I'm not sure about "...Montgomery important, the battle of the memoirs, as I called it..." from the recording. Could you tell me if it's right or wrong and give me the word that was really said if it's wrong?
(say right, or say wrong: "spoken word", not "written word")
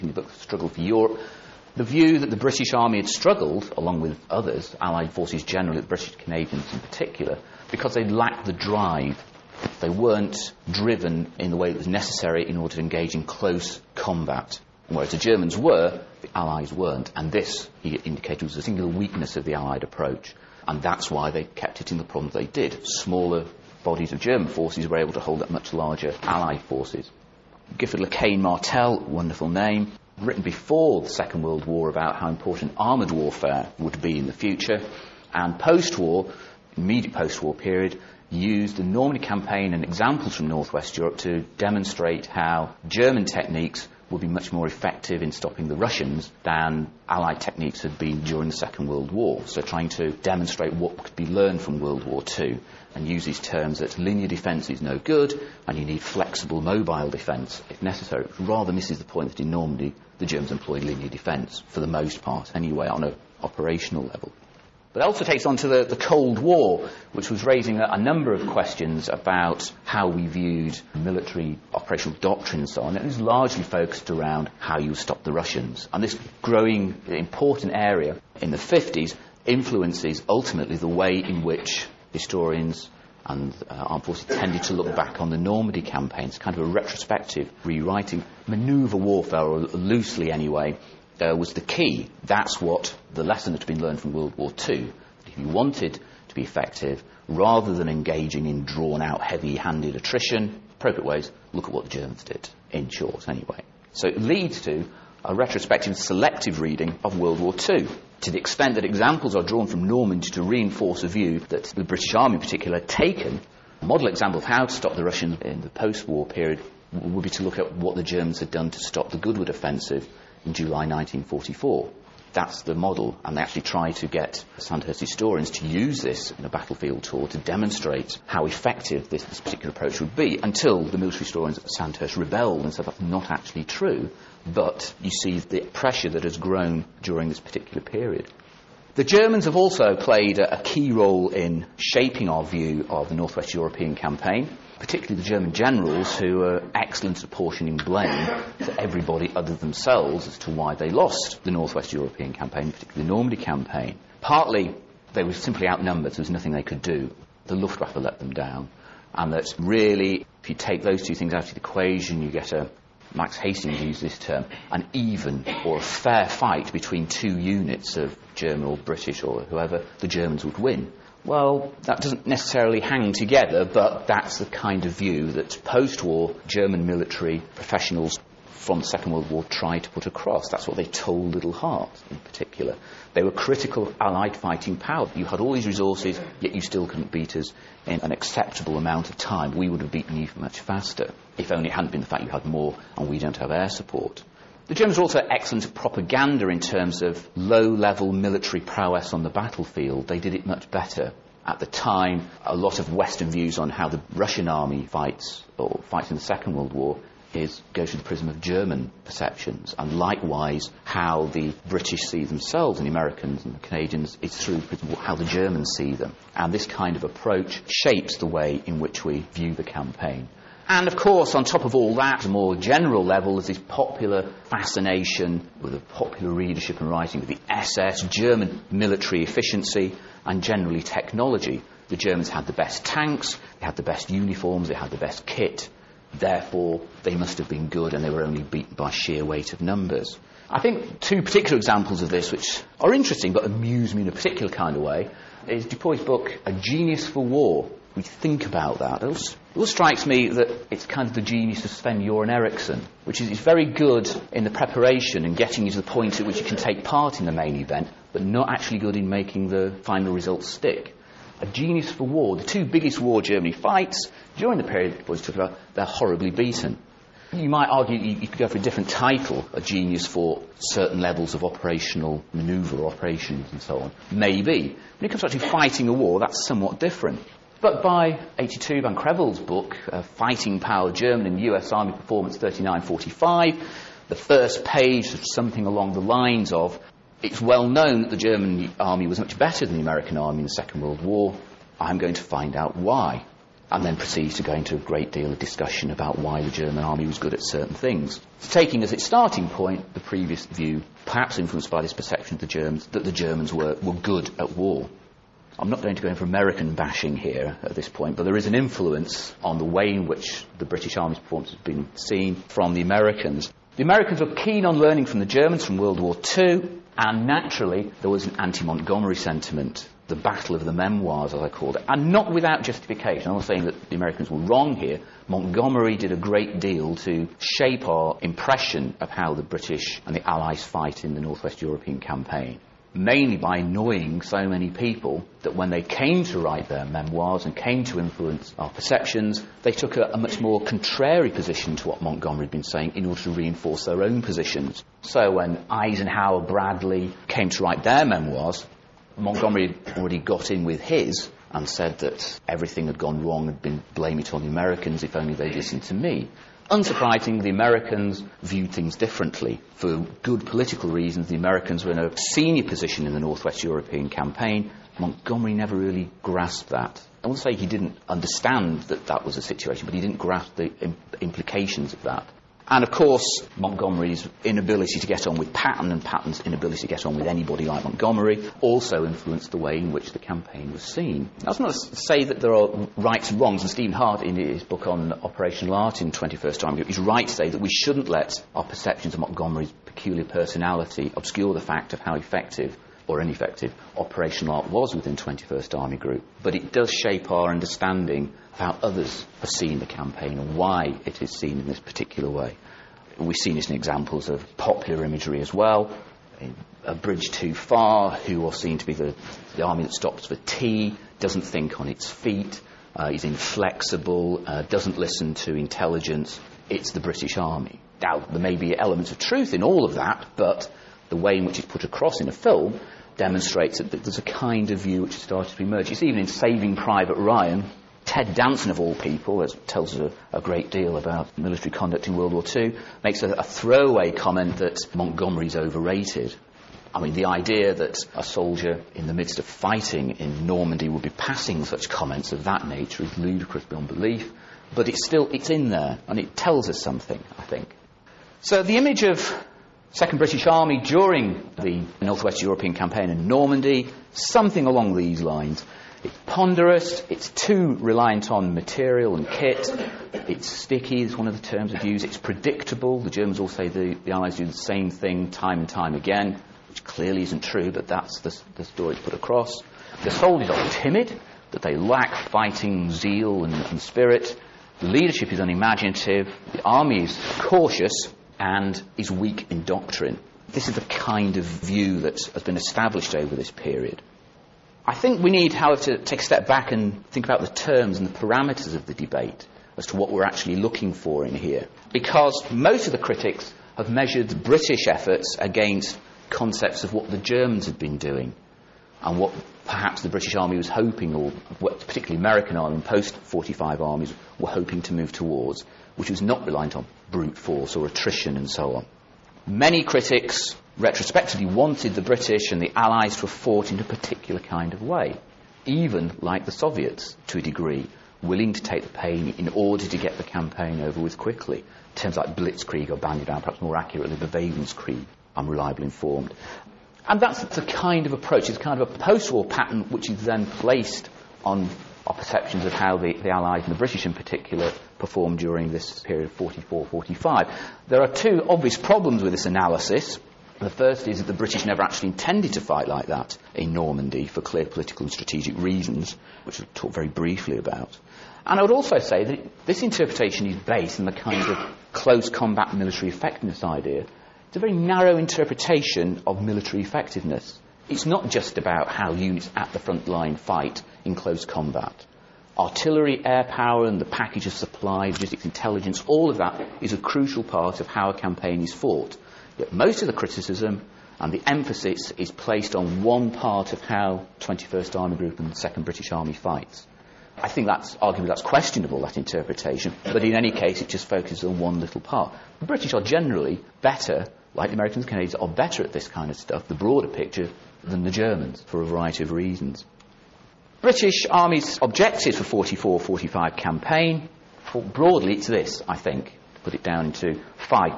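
wrong: "sentiment", not "important".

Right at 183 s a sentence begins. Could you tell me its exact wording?
They were critical Allied fighting power.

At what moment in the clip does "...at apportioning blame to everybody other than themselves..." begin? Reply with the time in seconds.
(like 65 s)
147 s.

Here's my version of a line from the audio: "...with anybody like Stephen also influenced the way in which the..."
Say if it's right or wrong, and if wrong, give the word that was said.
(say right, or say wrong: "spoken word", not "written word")
wrong: "Montgomery", not "Stephen".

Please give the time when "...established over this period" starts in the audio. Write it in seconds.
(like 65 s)
482 s.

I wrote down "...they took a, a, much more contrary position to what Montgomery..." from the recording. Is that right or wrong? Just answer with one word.
right.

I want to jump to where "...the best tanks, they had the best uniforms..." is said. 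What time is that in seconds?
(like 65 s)
232 s.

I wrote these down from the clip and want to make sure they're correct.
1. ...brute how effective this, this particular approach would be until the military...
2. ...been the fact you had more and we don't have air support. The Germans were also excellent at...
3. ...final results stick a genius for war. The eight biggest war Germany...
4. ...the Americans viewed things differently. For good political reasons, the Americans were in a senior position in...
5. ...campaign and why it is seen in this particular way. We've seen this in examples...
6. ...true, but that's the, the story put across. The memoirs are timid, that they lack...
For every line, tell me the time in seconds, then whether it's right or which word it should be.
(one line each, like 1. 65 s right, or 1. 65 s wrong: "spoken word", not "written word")
1. 127 s wrong: "demonstrate", not "brute"
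2. 191 s right
3. 259 s wrong: "two", not "eight"
4. 357 s right
5. 399 s right
6. 467 s wrong: "soldiers", not "memoirs".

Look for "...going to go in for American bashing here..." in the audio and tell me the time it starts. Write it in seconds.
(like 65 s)
305 s.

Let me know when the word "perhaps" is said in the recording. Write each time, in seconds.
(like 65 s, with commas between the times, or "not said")
301 s, 499 s, 523 s.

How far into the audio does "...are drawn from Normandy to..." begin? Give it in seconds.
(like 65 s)
109 s.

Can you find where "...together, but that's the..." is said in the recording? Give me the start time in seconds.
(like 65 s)
173 s.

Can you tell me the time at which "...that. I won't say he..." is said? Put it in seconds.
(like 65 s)
366 s.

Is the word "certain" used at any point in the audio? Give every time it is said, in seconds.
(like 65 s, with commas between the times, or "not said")
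270 s, 297 s.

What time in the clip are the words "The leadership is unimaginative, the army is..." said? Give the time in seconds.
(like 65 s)
474 s.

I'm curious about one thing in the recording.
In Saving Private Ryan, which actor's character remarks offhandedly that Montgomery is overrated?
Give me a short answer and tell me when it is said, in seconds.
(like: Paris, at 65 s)
Ted Danson, at 428 s.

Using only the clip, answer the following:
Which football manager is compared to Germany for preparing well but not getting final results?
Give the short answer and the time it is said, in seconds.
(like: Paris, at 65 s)
Sven Göran Eriksson, at 251 s.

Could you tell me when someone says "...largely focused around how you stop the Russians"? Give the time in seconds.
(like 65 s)
73 s.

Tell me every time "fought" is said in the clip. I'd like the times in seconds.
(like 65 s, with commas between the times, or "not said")
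513 s, 568 s.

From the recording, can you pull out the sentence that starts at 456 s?
It's ponderous, it's too reliant on material and kit, it's sticky, is one of the terms of use, it's predictable.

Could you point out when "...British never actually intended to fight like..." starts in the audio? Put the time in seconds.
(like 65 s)
541 s.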